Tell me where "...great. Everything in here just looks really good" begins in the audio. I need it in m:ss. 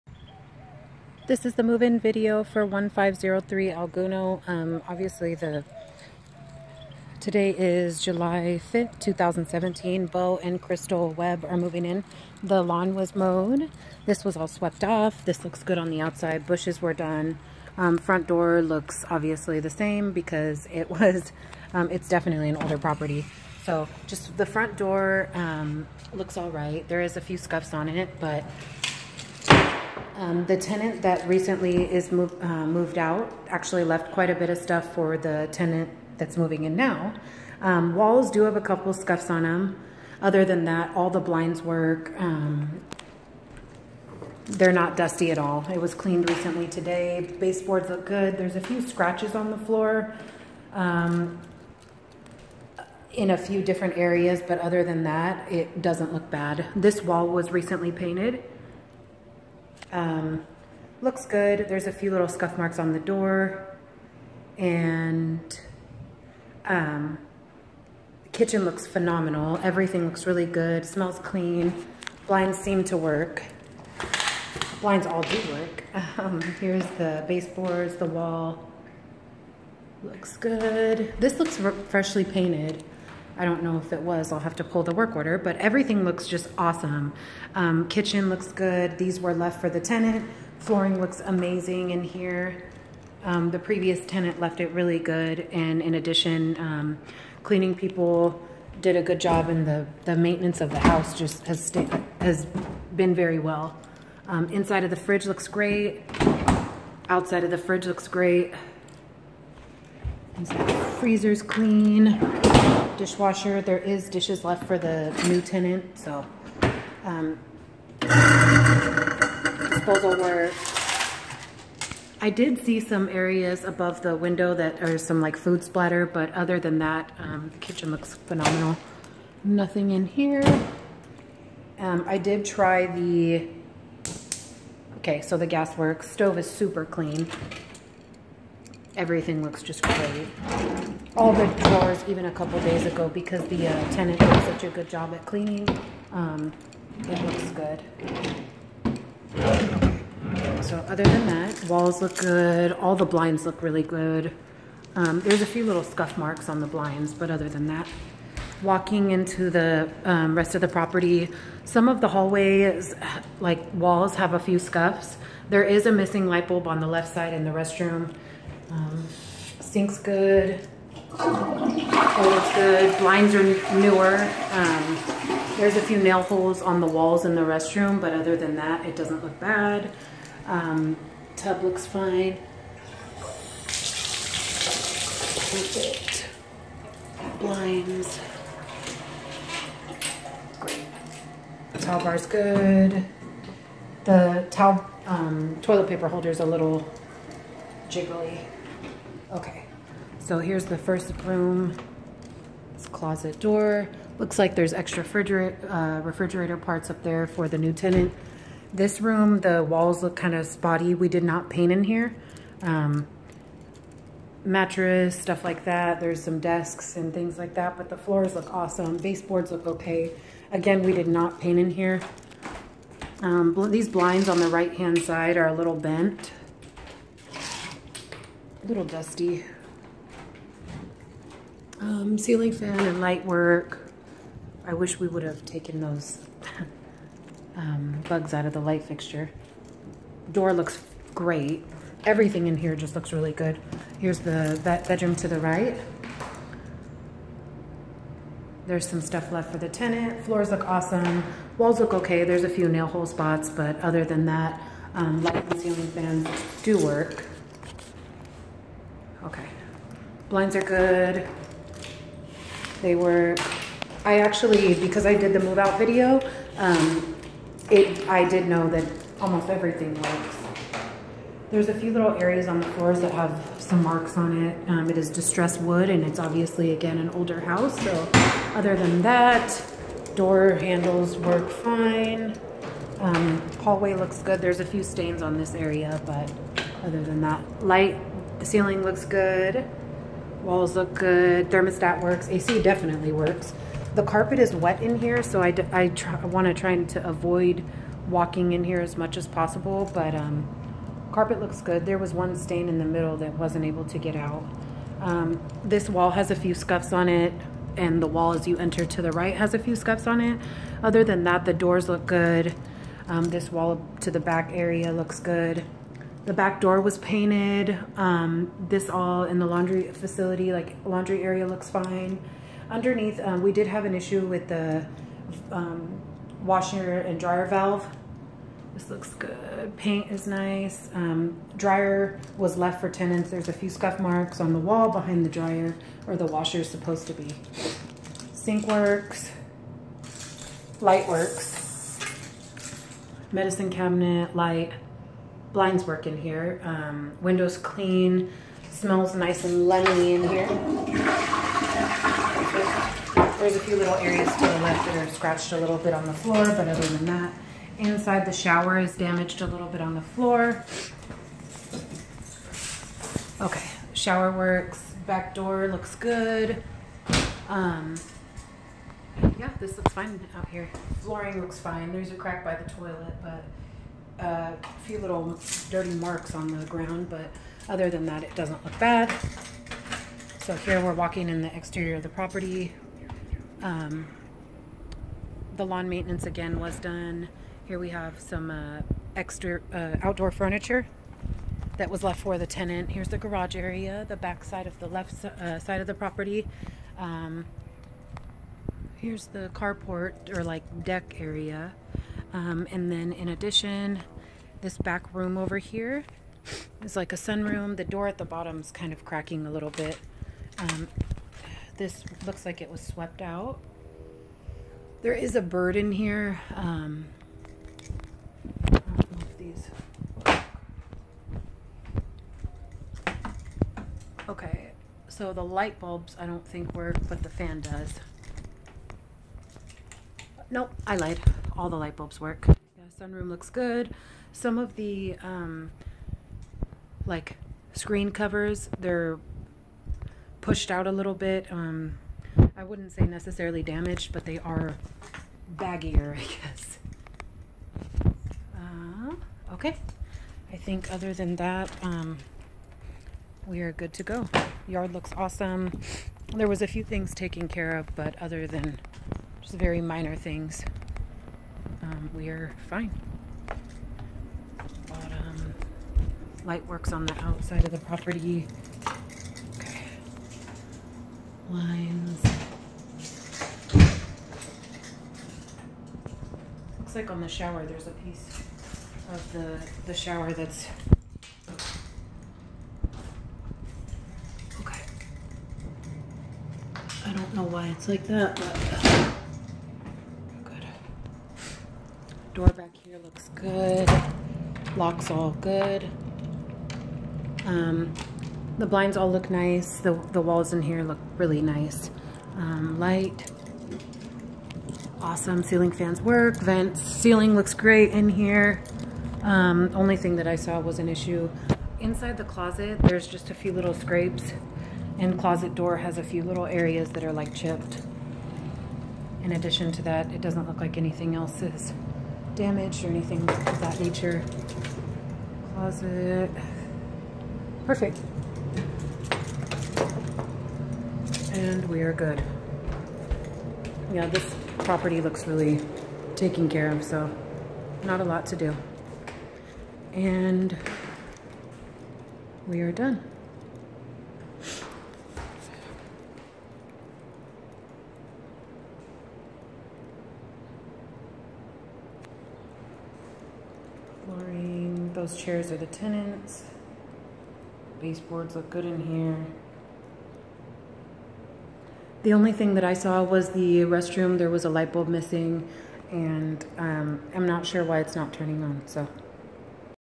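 4:01.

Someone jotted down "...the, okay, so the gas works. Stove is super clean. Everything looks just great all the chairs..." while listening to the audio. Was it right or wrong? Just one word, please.
wrong.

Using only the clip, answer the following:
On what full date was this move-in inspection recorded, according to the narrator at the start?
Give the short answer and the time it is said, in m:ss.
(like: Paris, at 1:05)
July 5th, 2017, at 0:08.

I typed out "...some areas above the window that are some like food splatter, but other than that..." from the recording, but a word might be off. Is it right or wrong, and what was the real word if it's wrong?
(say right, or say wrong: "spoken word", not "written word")
right.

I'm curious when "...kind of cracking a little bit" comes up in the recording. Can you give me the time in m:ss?
6:48.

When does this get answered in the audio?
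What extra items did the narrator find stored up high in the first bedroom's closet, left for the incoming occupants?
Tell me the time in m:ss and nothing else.
3:26.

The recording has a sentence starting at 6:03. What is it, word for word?
Okay, shower works, back door looks good.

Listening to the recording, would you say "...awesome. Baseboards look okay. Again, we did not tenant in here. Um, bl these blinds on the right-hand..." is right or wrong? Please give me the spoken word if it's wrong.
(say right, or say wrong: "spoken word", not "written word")
wrong: "paint", not "tenant".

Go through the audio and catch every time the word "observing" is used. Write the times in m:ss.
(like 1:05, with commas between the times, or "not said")
not said.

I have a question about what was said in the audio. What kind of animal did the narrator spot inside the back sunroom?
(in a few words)
bird.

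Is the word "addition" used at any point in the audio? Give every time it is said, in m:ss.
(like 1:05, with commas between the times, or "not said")
1:35, 6:43, 8:39.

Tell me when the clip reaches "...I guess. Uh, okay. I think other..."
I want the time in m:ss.
7:26.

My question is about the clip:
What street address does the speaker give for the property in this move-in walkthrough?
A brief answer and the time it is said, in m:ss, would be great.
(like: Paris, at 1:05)
1503 Alguno, at 0:02.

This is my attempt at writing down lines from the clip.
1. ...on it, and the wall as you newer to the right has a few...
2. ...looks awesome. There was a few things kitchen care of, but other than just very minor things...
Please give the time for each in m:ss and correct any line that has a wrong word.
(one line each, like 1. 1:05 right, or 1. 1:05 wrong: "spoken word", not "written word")
1. 5:06 wrong: "enter", not "newer"
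2. 7:34 wrong: "taken", not "kitchen".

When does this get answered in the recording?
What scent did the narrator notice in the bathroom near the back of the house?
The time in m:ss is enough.
5:49.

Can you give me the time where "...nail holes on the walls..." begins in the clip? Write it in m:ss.
2:55.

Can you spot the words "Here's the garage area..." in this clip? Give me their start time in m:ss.
6:32.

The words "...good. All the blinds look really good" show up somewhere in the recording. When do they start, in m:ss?
2:32.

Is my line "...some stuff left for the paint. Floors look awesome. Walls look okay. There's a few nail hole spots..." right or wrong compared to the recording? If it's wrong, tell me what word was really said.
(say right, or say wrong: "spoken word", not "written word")
wrong: "tenant", not "paint".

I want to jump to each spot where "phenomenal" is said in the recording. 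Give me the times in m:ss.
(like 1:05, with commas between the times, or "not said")
1:08, 2:08.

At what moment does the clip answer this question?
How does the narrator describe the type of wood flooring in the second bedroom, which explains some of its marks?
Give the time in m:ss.
4:35.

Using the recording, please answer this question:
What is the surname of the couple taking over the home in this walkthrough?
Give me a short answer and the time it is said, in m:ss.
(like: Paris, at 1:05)
Webb, at 0:11.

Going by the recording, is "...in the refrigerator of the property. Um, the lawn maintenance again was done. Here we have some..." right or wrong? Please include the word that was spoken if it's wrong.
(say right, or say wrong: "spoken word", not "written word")
wrong: "exterior", not "refrigerator".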